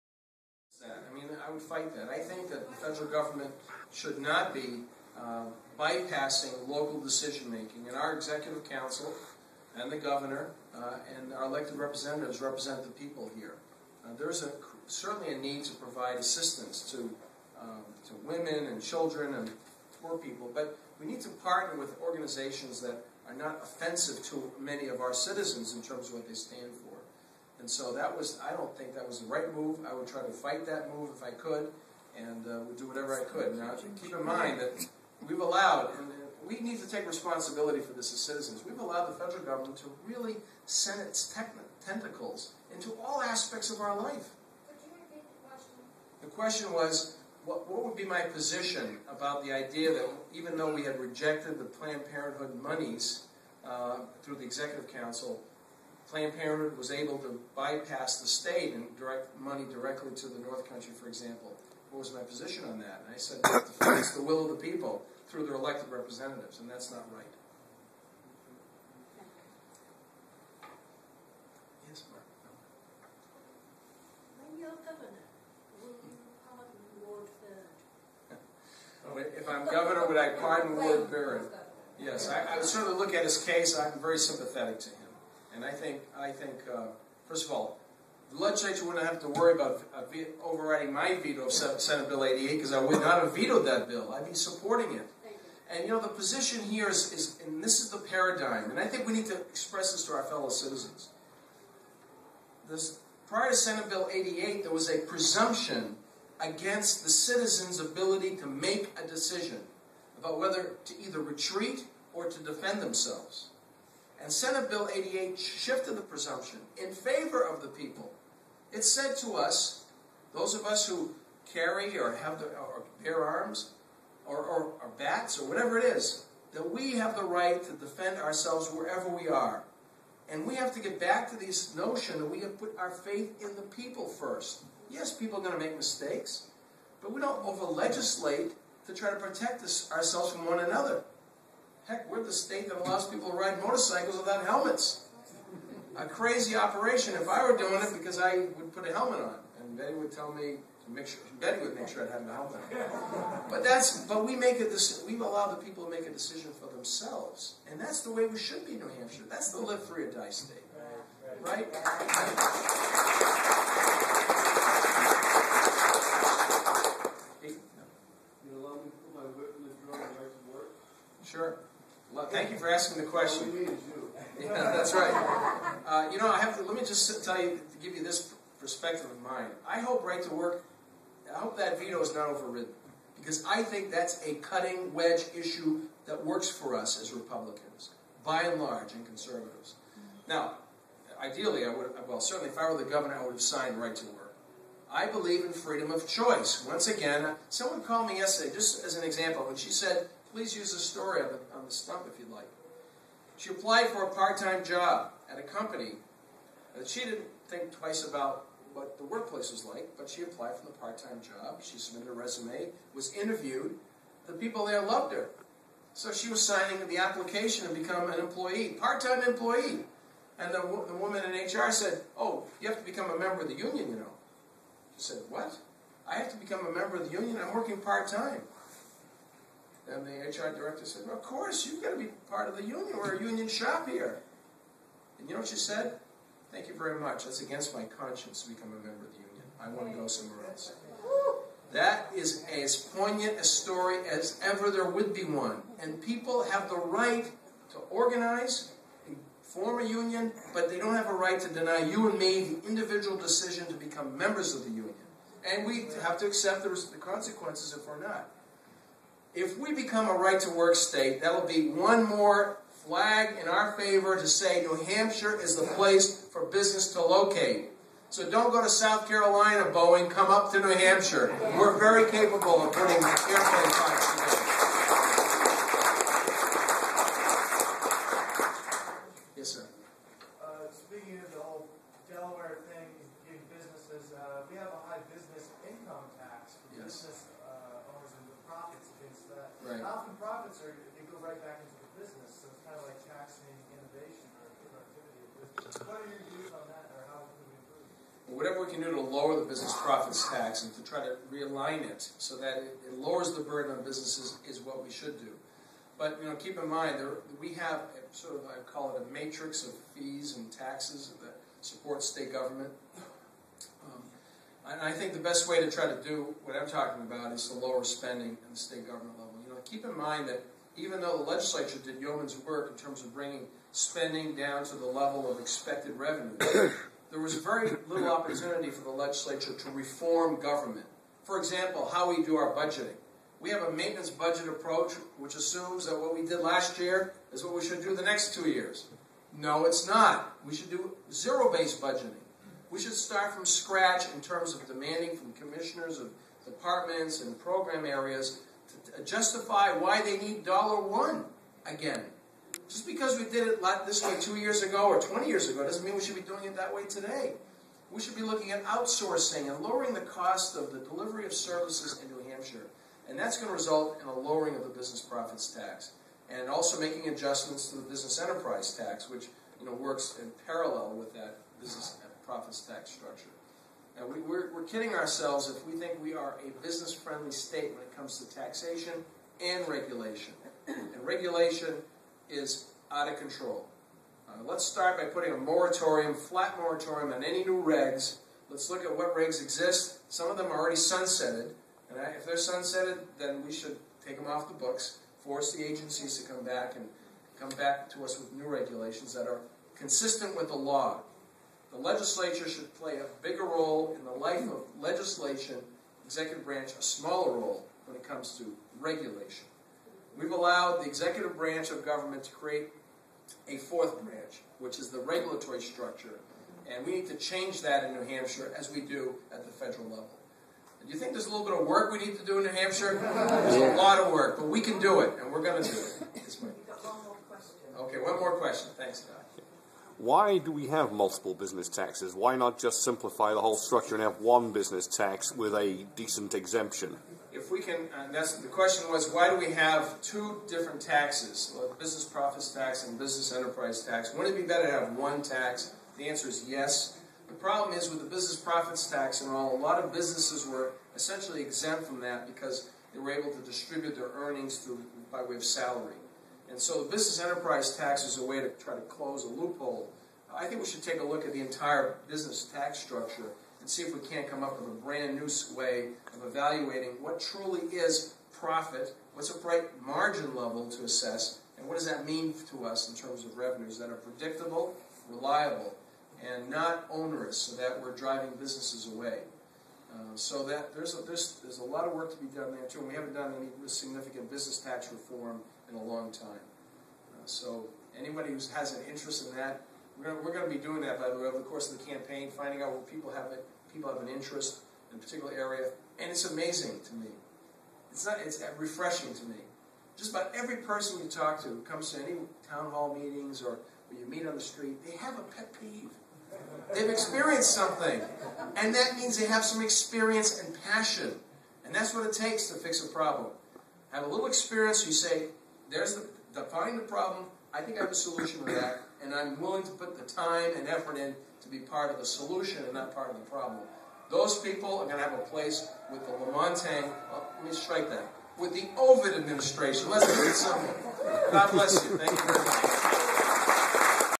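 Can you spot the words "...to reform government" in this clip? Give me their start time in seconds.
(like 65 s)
329 s.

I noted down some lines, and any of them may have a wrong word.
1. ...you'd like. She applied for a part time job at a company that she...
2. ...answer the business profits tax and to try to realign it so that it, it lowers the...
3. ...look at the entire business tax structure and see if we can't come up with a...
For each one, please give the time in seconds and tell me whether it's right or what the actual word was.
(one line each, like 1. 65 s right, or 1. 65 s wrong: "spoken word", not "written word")
1. 202 s right
2. 299 s wrong: "lower", not "answer"
3. 461 s right.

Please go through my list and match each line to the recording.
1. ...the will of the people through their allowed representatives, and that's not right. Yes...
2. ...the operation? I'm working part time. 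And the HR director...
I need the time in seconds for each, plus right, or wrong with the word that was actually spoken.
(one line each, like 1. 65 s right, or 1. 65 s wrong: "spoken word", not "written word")
1. 64 s wrong: "elected", not "allowed"
2. 227 s wrong: "union", not "operation".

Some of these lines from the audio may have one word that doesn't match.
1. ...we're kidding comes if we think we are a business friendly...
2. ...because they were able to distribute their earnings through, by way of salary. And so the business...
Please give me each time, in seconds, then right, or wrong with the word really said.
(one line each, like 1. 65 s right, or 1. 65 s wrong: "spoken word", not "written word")
1. 374 s wrong: "ourselves", not "comes"
2. 452 s right.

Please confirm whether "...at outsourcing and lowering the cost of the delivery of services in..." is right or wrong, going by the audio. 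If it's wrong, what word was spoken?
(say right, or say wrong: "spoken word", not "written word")
right.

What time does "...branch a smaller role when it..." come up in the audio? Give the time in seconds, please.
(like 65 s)
406 s.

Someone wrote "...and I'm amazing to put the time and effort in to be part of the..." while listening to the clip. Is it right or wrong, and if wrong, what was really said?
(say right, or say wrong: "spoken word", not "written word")
wrong: "willing", not "amazing".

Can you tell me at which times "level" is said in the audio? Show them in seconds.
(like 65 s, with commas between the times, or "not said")
319 s, 324 s, 419 s, 470 s.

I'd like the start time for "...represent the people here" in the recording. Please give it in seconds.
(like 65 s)
12 s.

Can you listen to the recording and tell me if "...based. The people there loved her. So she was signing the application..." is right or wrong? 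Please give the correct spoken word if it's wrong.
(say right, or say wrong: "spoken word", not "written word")
wrong: "interviewed", not "based".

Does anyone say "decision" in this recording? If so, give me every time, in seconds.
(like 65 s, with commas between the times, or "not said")
7 s, 109 s, 156 s, 253 s.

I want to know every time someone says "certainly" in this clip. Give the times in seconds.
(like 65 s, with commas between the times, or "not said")
14 s, 82 s, 192 s.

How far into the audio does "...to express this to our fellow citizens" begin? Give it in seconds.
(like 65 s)
99 s.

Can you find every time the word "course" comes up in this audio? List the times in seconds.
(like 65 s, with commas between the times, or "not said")
231 s, 491 s.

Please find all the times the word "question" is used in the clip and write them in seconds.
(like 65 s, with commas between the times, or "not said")
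46 s, 173 s, 428 s, 438 s.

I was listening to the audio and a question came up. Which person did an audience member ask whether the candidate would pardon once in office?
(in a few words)
Ward Bird.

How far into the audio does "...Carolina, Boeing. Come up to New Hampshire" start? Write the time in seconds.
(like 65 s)
269 s.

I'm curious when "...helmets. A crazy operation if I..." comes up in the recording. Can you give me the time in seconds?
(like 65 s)
144 s.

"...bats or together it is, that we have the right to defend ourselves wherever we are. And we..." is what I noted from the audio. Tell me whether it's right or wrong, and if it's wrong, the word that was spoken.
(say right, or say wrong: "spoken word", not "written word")
wrong: "whatever", not "together".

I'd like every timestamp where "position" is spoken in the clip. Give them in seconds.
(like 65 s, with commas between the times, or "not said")
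48 s, 62 s, 96 s.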